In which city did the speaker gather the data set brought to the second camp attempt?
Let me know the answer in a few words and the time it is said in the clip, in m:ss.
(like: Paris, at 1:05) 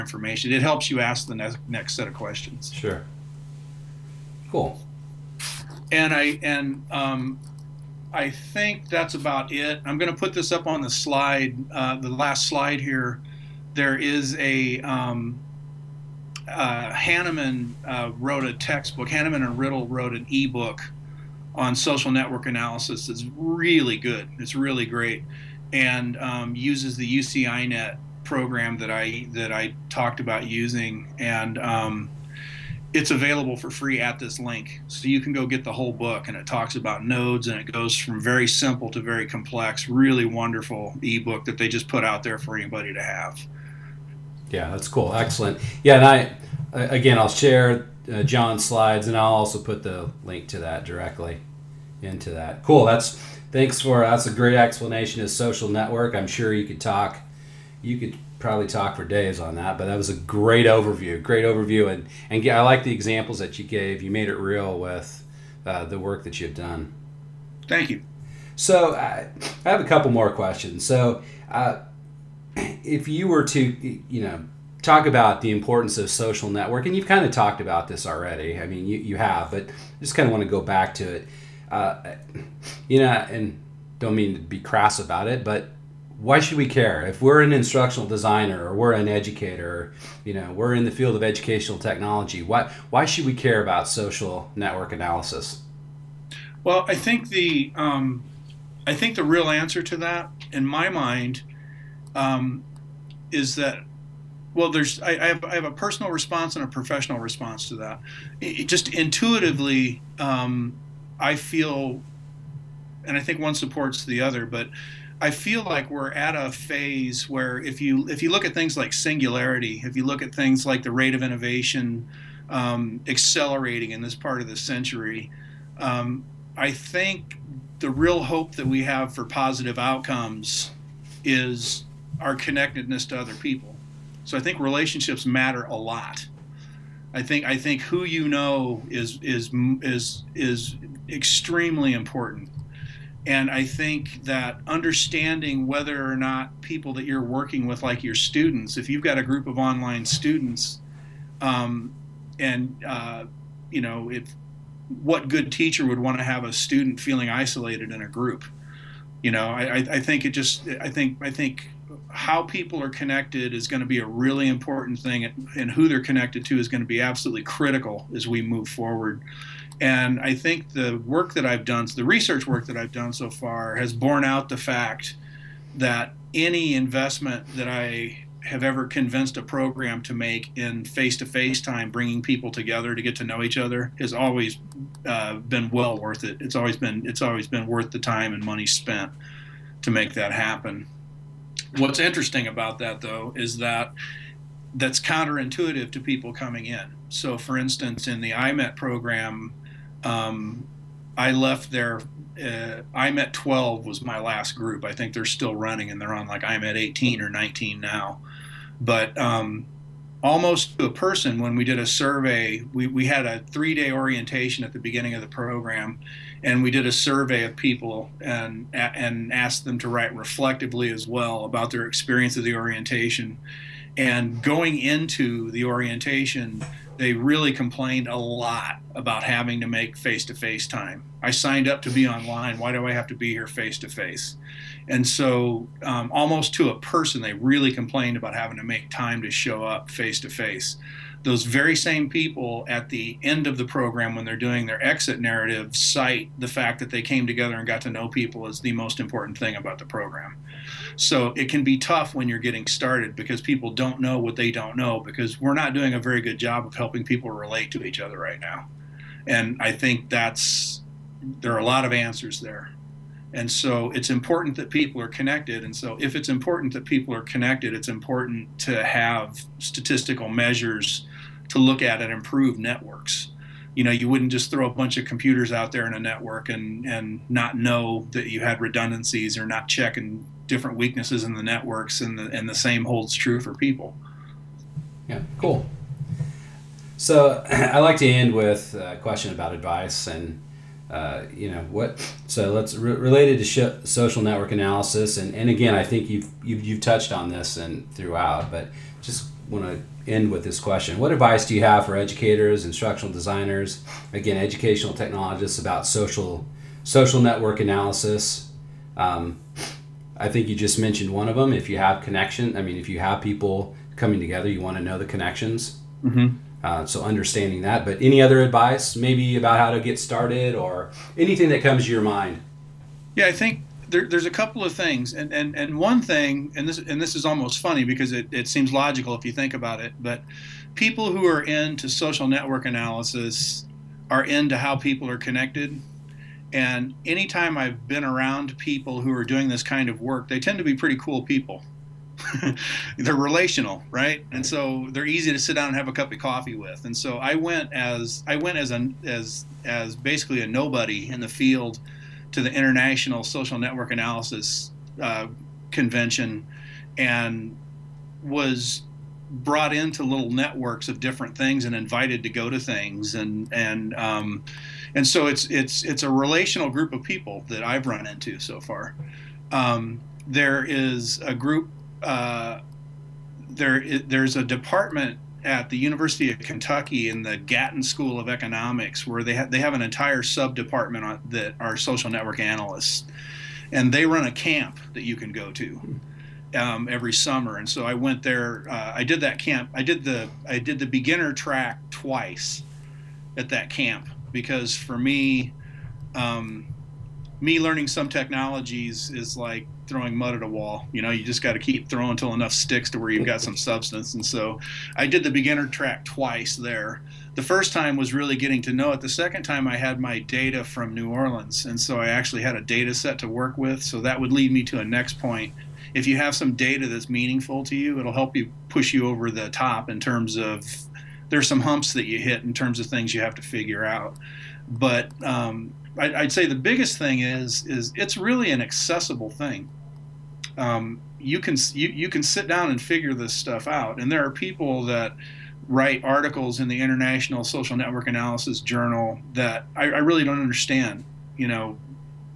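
New Orleans, at 6:50.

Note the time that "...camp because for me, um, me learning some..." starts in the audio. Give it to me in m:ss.
6:33.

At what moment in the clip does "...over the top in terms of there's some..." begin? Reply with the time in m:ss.
6:59.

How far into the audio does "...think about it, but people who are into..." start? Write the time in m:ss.
5:29.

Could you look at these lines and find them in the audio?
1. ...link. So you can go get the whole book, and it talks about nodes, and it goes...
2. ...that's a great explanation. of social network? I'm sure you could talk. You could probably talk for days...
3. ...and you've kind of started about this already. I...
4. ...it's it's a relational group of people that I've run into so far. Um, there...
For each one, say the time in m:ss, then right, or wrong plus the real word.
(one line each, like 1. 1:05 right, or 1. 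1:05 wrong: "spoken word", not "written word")
1. 0:34 right
2. 0:54 right
3. 1:16 wrong: "talked", not "started"
4. 6:05 right.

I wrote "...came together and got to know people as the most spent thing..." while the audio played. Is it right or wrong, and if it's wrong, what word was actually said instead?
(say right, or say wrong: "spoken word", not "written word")
wrong: "important", not "spent".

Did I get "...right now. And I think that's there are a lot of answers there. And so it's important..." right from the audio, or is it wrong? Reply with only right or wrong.
right.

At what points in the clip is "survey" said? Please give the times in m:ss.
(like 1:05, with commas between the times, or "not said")
3:31, 3:36.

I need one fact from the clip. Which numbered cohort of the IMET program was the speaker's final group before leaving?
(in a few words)
IMET 12.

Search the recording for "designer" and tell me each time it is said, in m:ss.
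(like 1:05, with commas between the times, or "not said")
1:28, 5:03.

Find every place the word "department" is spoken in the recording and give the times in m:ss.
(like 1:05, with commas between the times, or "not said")
6:14, 6:20.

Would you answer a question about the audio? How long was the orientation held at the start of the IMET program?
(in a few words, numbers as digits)
three day.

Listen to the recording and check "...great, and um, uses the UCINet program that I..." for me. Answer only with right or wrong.
right.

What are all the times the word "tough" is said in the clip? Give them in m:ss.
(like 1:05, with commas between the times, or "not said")
4:11.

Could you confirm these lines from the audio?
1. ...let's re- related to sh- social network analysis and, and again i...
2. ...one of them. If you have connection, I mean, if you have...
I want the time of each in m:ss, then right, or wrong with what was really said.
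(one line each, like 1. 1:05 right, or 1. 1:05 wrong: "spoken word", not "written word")
1. 4:52 right
2. 5:11 right.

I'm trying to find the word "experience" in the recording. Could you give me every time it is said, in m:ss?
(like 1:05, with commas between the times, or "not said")
3:41.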